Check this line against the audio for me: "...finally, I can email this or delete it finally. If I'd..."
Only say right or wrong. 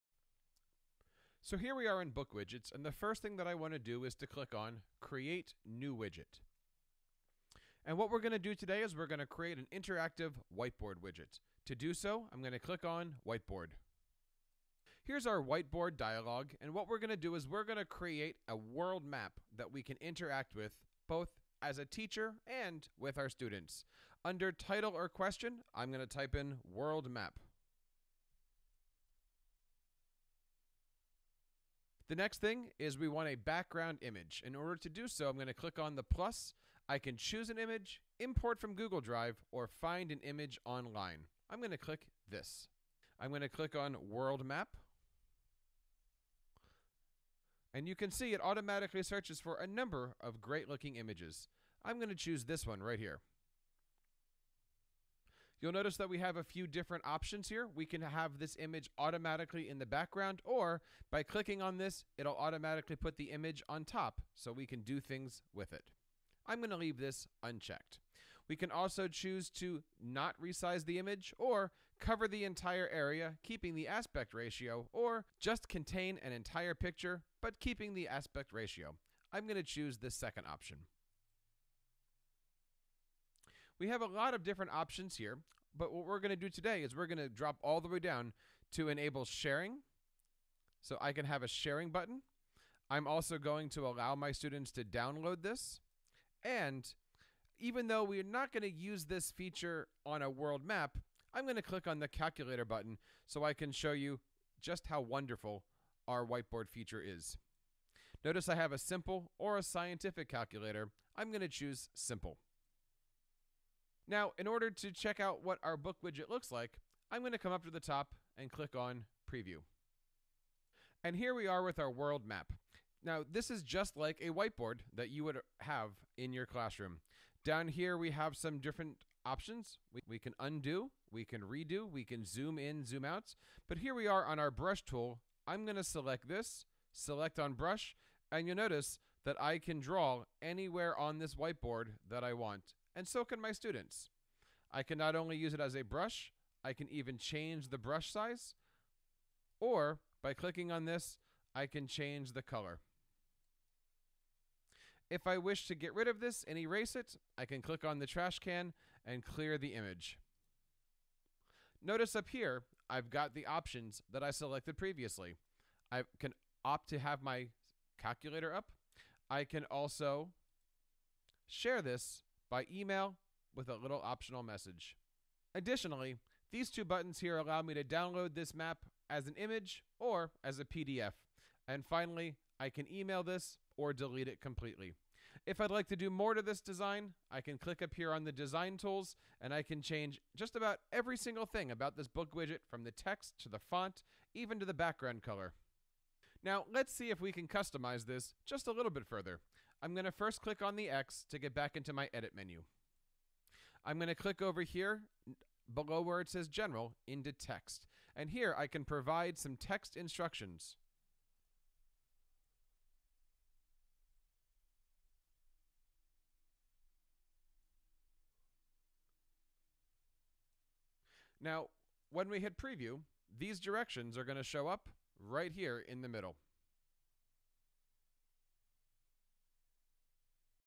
wrong.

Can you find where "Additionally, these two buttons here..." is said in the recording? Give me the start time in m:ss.
2:55.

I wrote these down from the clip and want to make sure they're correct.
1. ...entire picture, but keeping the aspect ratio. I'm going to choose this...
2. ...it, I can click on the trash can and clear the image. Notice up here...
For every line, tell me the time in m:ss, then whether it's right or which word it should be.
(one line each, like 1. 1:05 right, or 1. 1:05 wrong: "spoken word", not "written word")
1. 1:16 right
2. 2:36 right.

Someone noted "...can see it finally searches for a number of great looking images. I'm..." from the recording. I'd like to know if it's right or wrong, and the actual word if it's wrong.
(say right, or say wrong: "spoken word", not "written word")
wrong: "automatically", not "finally".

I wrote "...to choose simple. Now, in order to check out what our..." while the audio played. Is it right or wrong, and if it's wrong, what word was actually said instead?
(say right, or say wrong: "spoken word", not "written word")
right.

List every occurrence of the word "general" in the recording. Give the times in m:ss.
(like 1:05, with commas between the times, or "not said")
3:26.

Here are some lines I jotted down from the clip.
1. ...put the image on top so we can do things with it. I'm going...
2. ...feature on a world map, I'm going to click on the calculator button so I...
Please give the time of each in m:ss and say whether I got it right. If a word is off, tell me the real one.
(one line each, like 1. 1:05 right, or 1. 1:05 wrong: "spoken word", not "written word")
1. 1:02 right
2. 1:39 right.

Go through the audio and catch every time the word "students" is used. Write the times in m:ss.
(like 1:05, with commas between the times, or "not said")
0:23, 1:34, 2:23.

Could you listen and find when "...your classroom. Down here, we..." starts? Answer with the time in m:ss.
2:06.